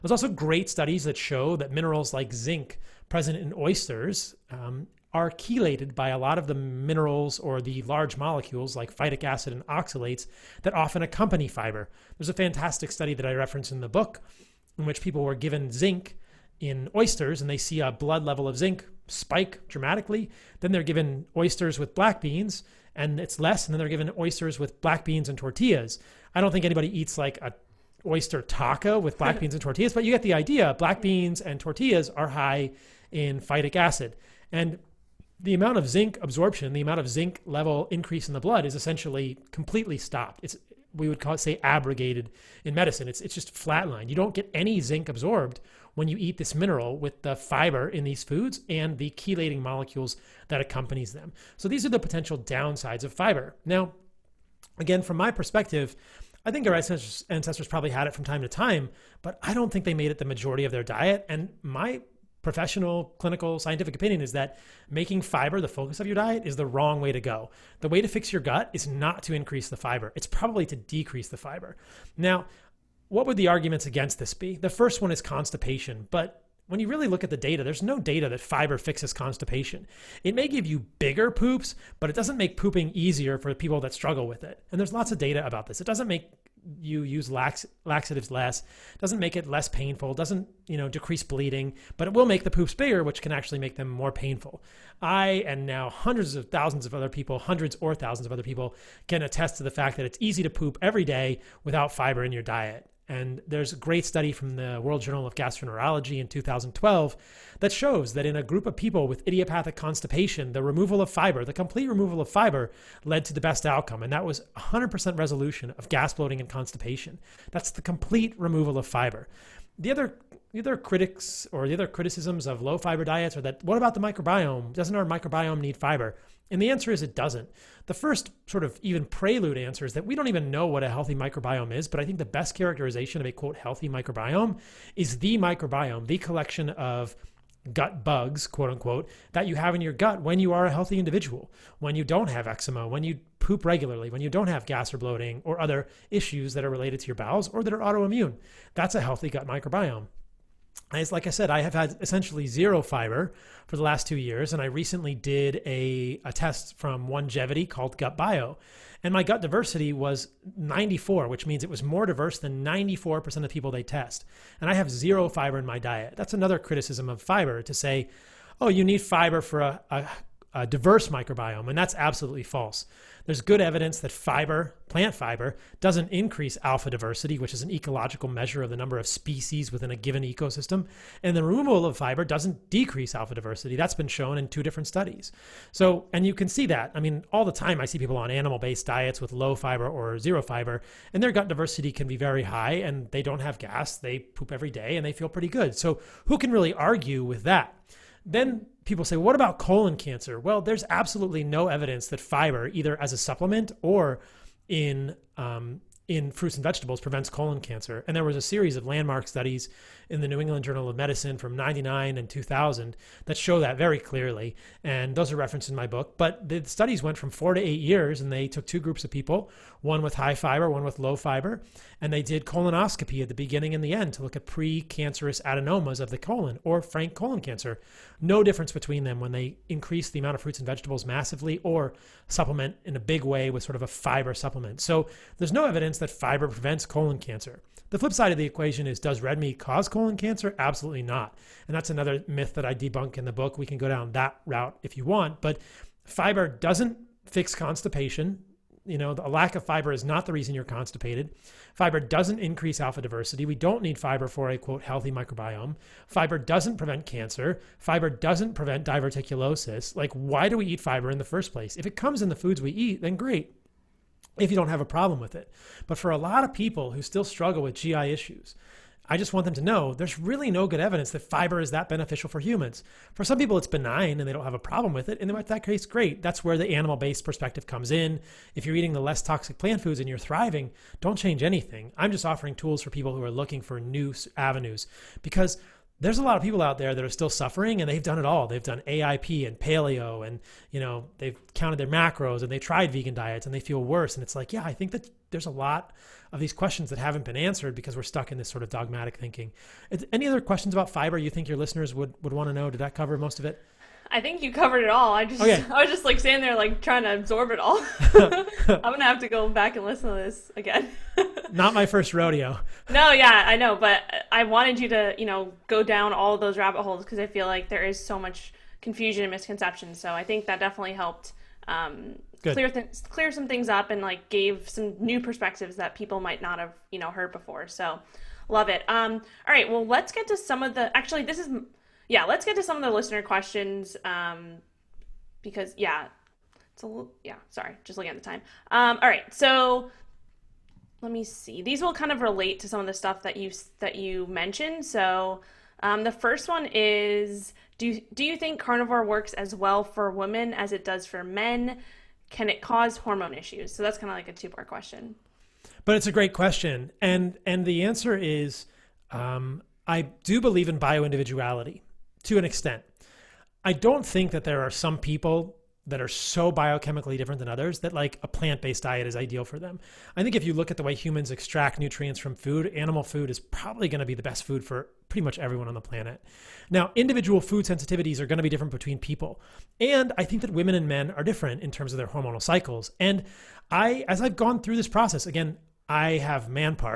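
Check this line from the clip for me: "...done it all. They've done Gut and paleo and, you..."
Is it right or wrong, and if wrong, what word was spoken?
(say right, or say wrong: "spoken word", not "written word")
wrong: "AIP", not "Gut".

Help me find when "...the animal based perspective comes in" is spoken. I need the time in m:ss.
4:36.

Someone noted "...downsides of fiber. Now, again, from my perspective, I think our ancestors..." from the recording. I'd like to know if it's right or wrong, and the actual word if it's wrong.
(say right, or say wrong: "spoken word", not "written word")
right.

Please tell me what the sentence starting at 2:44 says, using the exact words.
And I have zero fiber in my diet.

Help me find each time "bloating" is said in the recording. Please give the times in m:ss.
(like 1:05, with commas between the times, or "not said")
1:56, 2:24.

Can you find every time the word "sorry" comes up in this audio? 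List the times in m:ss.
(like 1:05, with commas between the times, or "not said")
5:37.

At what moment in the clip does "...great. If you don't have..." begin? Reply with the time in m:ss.
4:23.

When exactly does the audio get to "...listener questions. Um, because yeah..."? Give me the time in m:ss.
5:32.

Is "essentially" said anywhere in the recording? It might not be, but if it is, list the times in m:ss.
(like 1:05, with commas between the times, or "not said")
0:38, 2:32.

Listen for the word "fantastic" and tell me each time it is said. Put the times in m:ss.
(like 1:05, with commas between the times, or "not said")
0:12.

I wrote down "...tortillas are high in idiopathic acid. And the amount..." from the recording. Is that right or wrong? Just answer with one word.
wrong.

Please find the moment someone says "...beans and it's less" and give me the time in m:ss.
0:22.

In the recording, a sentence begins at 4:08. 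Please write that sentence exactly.
You know, a lack of fiber is not the reason you're constipated.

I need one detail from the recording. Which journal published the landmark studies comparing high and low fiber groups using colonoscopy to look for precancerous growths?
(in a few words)
New England Journal of Medicine.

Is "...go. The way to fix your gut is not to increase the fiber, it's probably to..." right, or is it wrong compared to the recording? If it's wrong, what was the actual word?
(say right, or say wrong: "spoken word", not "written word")
right.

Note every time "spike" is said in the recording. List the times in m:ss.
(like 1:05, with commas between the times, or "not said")
0:19.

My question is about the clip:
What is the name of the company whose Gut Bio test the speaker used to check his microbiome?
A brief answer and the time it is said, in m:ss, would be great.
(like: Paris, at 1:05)
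Onegevity, at 2:37.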